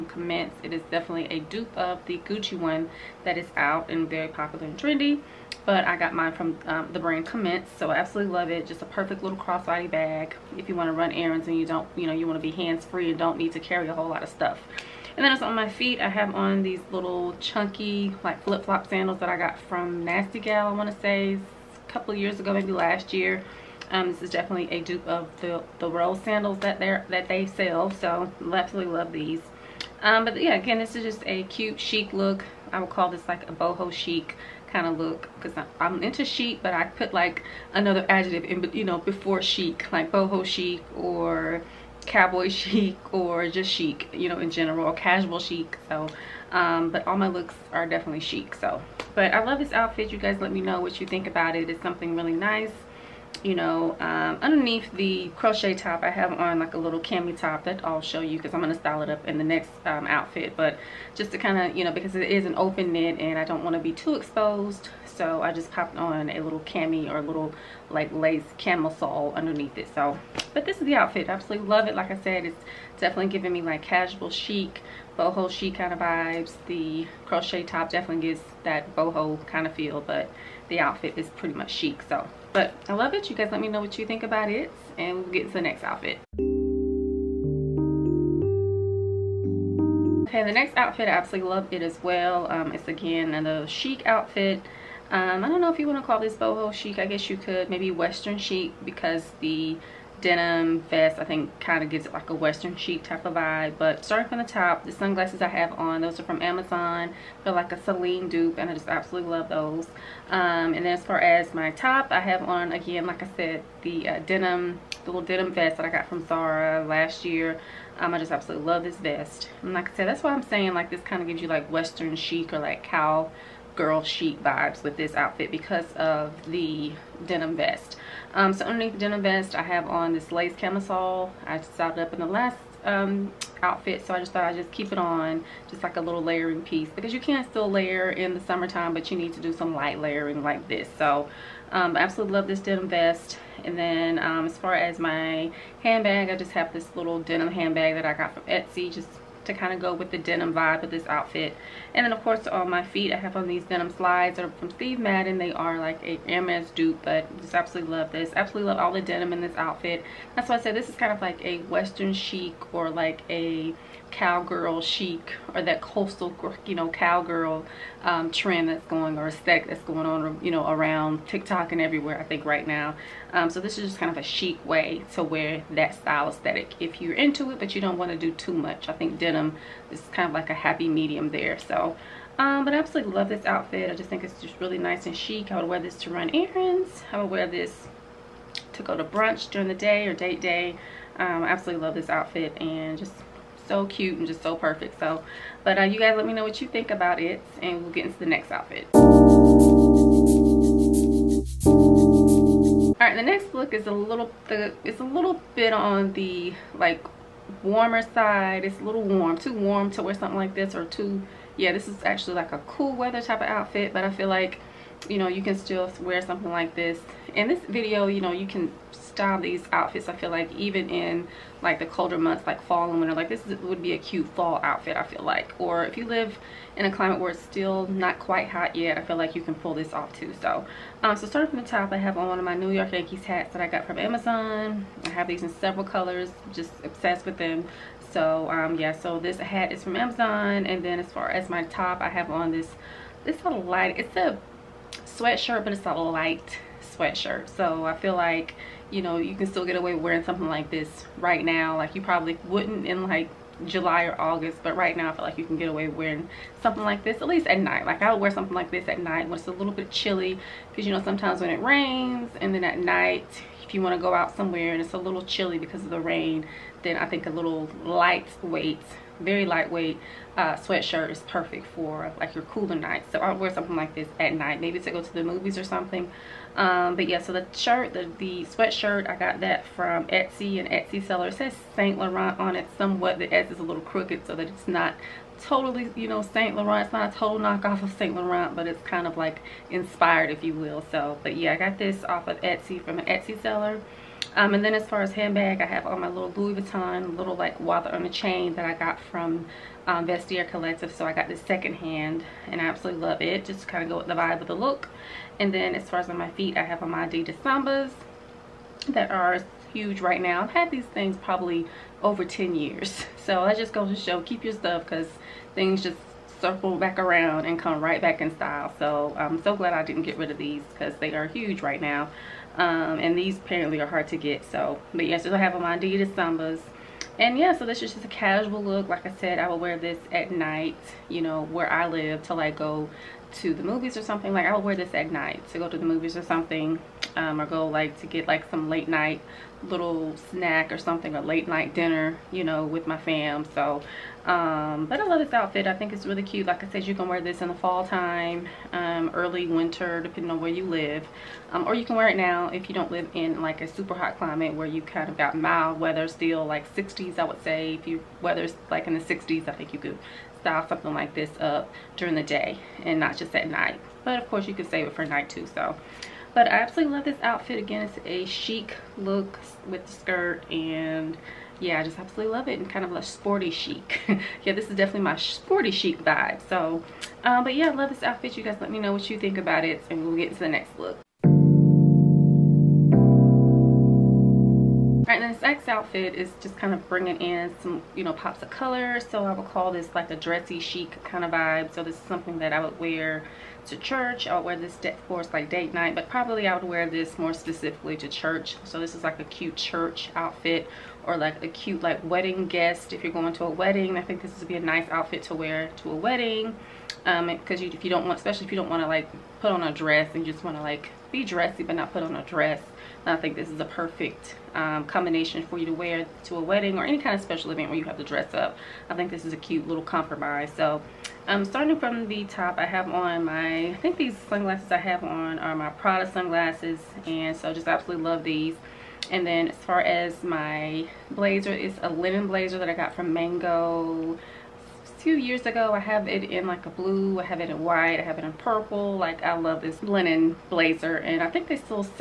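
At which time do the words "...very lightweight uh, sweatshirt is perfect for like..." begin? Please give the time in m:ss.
4:29.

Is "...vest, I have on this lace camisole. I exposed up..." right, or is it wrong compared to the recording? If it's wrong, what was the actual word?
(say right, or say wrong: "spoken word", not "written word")
wrong: "decided", not "exposed".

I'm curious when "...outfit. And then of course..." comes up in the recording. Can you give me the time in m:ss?
2:31.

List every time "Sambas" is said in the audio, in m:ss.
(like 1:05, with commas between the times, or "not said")
5:07, 5:26.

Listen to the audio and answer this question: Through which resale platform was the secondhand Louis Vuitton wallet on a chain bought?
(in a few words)
Vestiaire Collective.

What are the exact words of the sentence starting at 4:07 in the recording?
So I feel like, you know, you can still get away wearing something like this right now.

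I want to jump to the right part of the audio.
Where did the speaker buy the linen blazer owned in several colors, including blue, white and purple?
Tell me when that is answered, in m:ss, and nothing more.
7:13.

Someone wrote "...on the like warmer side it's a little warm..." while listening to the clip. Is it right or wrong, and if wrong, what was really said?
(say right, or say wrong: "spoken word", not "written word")
right.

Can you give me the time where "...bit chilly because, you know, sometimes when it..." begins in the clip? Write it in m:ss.
4:19.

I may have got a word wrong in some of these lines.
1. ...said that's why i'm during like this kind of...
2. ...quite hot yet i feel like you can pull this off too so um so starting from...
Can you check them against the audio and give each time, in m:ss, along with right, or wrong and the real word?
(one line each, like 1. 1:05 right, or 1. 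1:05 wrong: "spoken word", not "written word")
1. 1:59 wrong: "saying", not "during"
2. 3:48 right.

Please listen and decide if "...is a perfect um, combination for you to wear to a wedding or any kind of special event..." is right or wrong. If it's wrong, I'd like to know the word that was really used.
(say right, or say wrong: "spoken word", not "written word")
right.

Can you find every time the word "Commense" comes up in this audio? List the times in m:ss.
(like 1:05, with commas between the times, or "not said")
0:00, 0:07.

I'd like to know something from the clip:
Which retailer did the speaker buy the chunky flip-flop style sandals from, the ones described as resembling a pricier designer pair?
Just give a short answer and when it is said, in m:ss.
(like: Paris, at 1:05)
Nasty Gal, at 0:20.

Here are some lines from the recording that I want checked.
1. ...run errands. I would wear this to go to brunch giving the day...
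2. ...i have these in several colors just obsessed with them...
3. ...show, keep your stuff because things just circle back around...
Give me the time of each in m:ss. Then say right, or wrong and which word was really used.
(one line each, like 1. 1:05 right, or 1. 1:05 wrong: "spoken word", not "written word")
1. 3:06 wrong: "during", not "giving"
2. 3:55 right
3. 5:13 right.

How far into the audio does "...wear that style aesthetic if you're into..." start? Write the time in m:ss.
2:55.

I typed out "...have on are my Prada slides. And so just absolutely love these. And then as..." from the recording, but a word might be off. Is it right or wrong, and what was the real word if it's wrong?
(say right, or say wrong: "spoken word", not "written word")
wrong: "sunglasses", not "slides".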